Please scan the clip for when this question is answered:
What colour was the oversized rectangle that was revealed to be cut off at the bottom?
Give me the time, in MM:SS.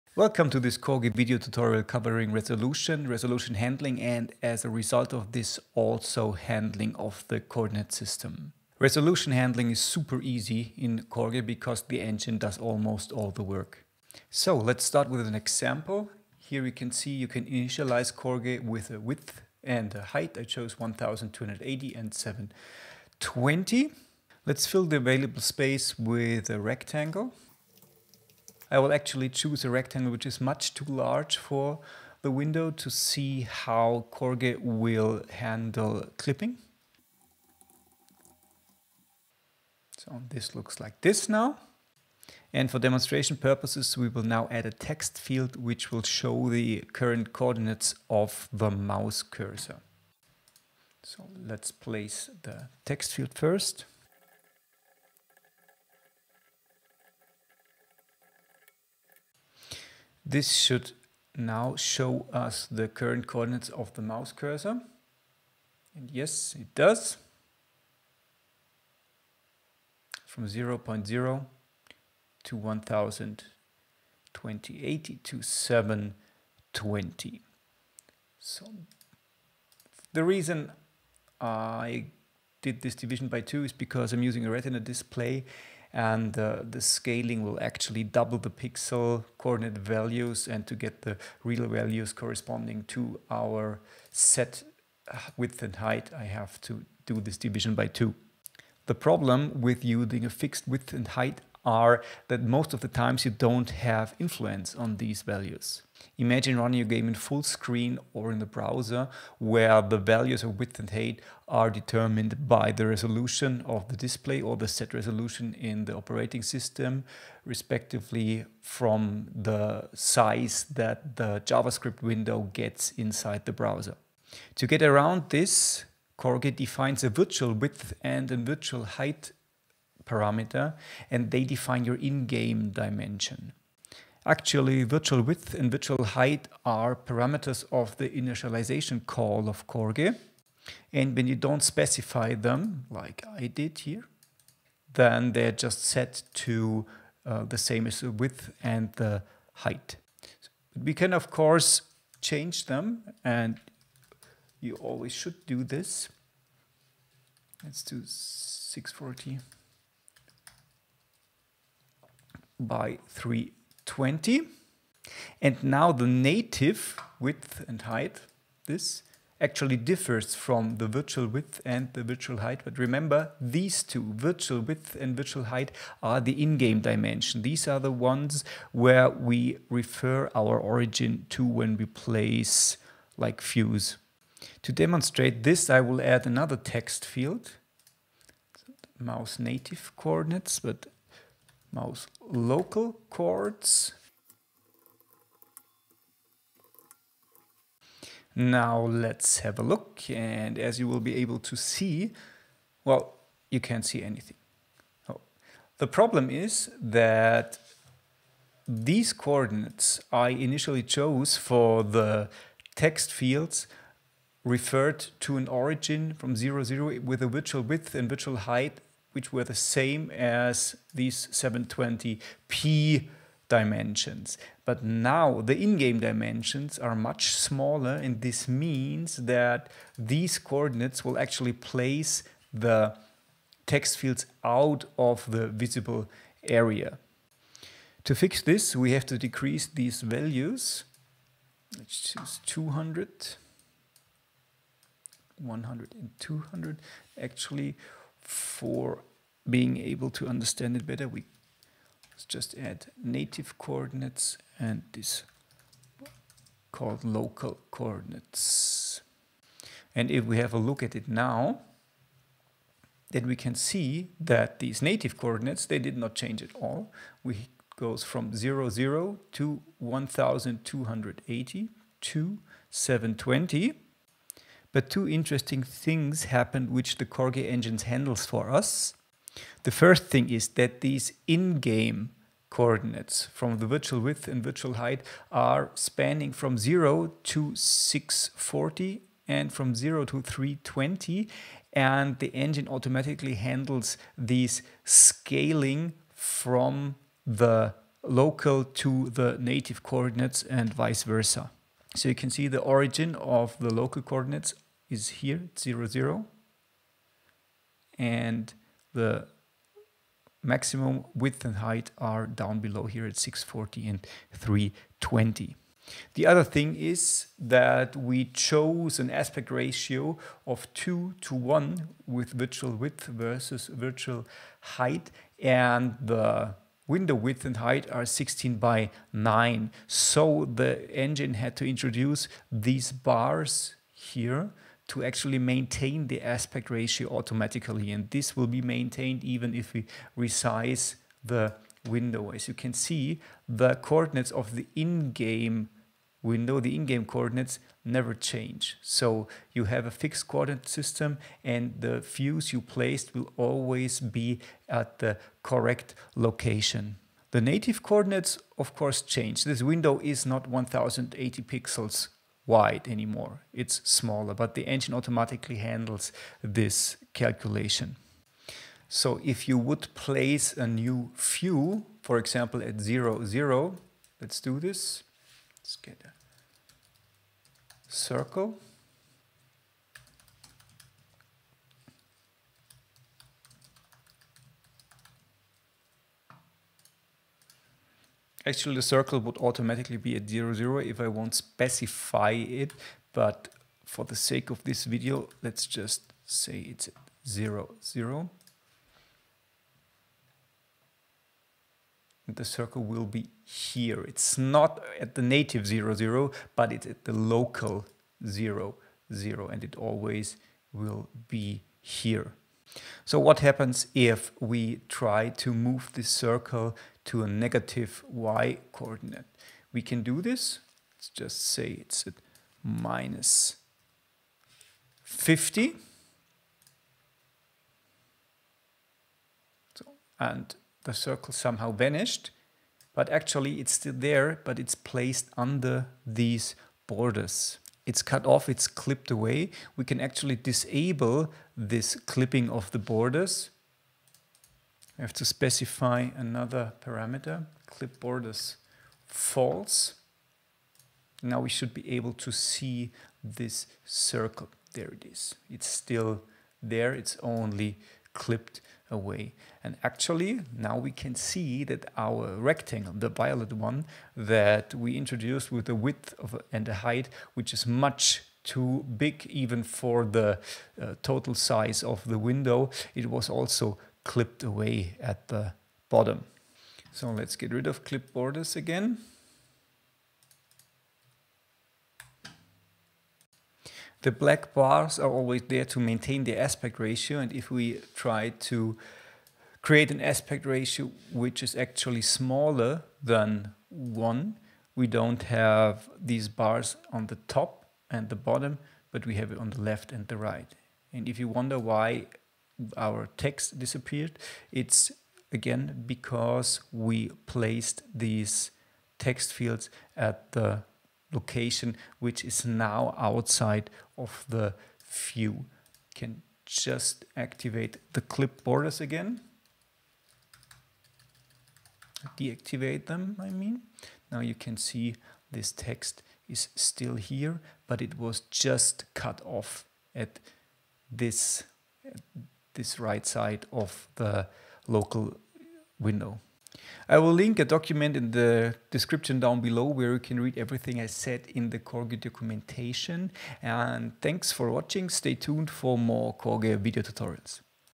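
07:43.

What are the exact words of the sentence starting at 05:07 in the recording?
And the maximum width and height are down below here at 640 and 320.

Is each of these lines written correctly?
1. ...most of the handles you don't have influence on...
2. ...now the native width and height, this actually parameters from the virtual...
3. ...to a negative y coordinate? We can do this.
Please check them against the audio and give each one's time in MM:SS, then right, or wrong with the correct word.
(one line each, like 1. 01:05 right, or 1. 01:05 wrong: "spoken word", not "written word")
1. 01:42 wrong: "times", not "handles"
2. 02:45 wrong: "differs", not "parameters"
3. 06:57 right.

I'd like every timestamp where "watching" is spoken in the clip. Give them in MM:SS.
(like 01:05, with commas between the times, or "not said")
09:04.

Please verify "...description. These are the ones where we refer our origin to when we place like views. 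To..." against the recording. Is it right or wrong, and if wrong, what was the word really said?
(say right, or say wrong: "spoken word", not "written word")
wrong: "dimension", not "description".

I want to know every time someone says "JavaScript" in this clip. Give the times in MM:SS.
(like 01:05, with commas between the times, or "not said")
02:01.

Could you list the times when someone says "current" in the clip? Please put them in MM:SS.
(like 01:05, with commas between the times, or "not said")
00:46, 01:02.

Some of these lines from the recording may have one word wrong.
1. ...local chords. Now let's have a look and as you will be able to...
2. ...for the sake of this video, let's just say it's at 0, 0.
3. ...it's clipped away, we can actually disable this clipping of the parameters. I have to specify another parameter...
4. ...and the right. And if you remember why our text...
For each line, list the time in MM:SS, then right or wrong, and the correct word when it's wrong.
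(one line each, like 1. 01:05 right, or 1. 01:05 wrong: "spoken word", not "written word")
1. 03:12 right
2. 06:33 right
3. 07:18 wrong: "borders", not "parameters"
4. 08:19 wrong: "wonder", not "remember".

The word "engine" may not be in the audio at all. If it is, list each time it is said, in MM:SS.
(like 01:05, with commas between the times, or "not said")
00:12, 04:37, 04:52, 05:30, 06:04.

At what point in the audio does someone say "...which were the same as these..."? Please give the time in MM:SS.
03:39.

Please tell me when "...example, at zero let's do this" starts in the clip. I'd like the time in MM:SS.
06:12.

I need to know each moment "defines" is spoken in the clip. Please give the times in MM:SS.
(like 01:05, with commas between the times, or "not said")
02:06, 02:11.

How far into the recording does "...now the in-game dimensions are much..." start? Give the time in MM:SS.
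03:44.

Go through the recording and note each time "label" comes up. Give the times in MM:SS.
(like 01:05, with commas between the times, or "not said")
not said.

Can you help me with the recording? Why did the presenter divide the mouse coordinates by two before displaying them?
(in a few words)
retina display.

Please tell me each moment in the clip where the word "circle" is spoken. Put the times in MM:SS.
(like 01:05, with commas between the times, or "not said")
06:17, 06:28, 06:42, 06:56, 07:10, 07:33.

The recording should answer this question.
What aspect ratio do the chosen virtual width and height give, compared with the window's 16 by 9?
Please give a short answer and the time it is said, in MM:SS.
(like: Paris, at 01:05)
2 to 1, at 05:20.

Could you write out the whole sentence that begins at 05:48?
So you have a fixed coordinate system and the views you placed will always be at the correct location.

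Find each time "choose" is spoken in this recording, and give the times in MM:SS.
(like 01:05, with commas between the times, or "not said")
00:29, 04:02.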